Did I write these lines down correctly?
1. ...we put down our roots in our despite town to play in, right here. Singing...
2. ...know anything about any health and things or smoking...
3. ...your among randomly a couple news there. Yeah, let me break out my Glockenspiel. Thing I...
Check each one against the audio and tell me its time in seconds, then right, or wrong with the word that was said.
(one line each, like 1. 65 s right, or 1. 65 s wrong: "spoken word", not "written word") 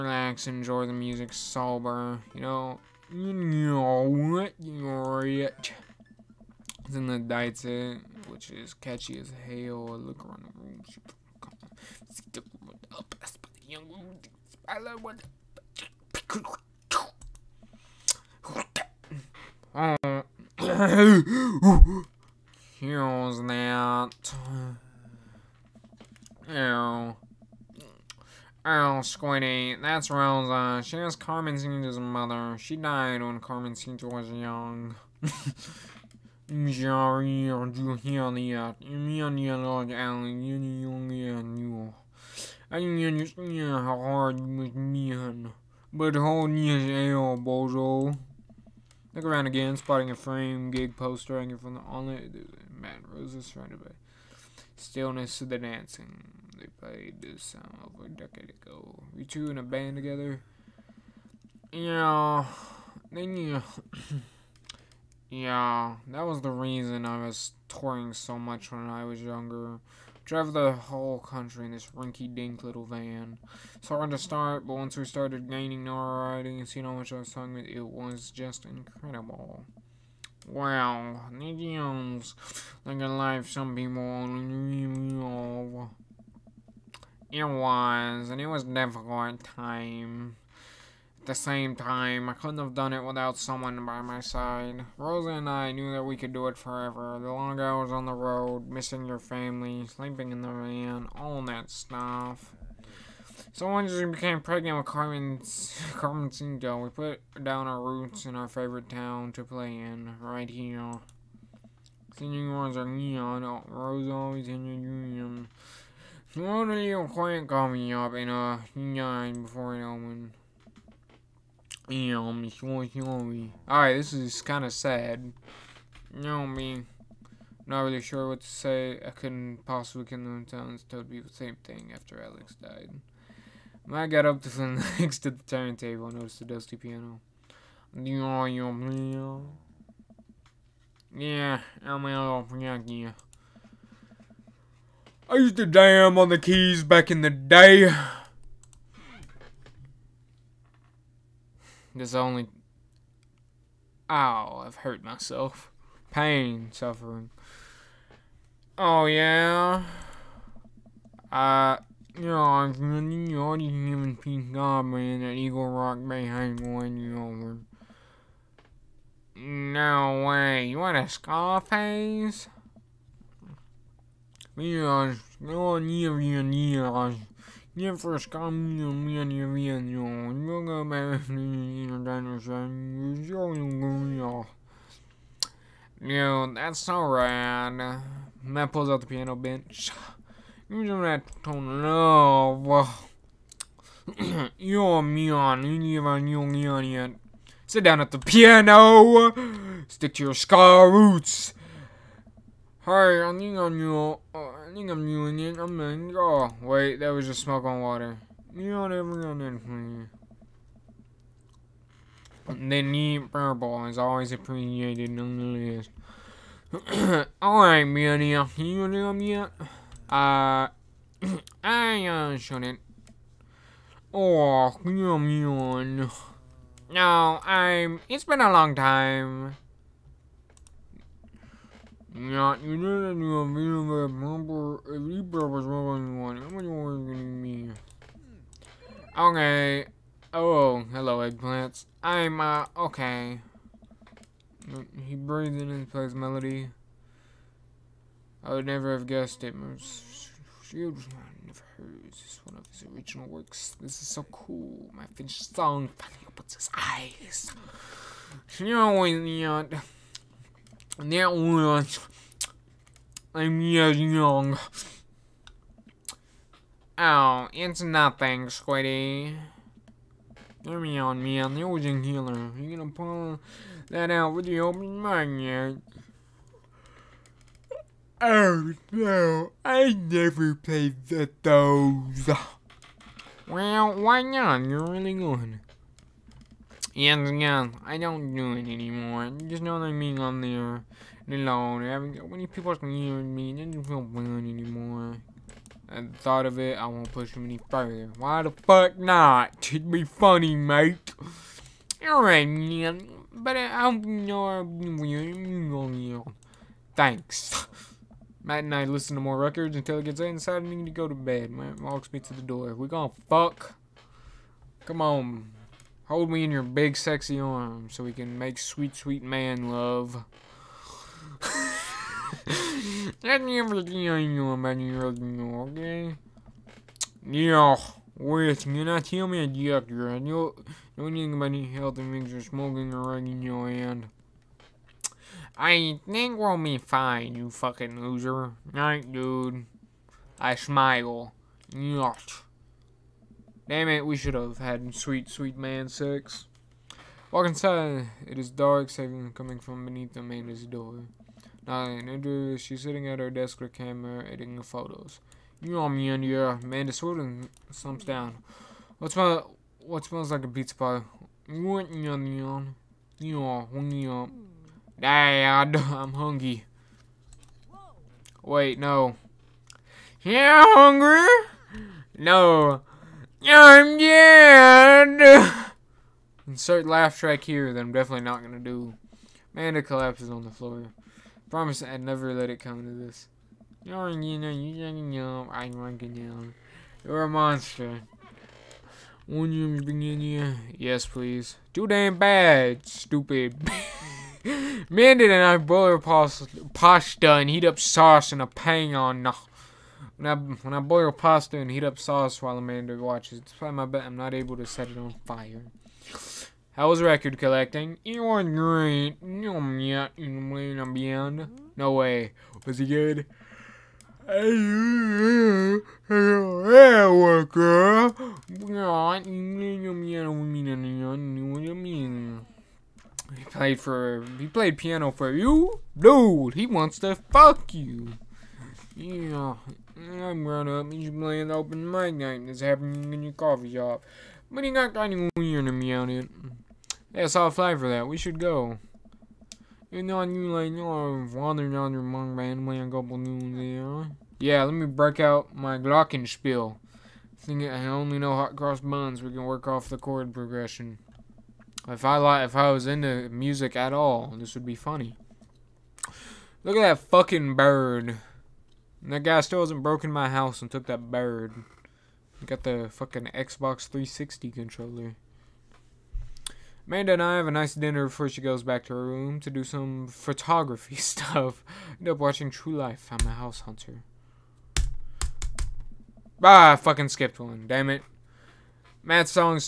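1. 106 s wrong: "favorite", not "despite"
2. 330 s right
3. 441 s right.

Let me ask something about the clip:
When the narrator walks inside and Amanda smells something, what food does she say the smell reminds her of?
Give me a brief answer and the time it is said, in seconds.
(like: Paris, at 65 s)
pizza pie, at 360 s.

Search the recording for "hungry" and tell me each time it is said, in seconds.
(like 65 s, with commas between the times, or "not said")
366 s, 370 s.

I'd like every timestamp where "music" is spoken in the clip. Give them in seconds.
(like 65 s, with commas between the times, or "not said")
0 s, 453 s.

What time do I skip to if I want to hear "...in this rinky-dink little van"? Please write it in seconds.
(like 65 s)
71 s.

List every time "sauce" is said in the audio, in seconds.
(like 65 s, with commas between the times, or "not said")
397 s, 401 s.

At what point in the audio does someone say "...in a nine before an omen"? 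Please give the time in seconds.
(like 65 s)
118 s.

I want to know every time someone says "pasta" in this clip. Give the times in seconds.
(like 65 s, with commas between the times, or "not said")
395 s, 401 s.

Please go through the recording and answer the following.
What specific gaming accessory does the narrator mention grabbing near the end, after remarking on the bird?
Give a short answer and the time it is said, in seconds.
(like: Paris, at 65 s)
Xbox 360 controller, at 463 s.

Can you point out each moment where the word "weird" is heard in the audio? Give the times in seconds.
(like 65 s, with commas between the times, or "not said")
304 s, 435 s.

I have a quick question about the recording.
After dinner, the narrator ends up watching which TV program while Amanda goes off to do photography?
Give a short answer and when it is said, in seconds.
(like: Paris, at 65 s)
True Life, at 472 s.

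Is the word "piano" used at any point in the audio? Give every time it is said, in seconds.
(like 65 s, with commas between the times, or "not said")
136 s, 189 s, 198 s, 424 s.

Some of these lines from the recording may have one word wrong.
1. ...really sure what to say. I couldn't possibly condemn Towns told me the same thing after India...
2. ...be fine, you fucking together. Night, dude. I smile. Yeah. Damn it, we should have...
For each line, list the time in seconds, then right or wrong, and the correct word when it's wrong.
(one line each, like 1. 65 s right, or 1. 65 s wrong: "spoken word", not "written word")
1. 127 s wrong: "Alex", not "India"
2. 336 s wrong: "loser", not "together".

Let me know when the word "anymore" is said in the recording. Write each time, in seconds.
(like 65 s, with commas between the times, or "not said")
288 s, 294 s.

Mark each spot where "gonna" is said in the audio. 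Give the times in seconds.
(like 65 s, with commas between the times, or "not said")
236 s, 272 s, 312 s, 378 s.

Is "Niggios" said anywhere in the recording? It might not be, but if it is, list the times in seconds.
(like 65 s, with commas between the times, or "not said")
81 s.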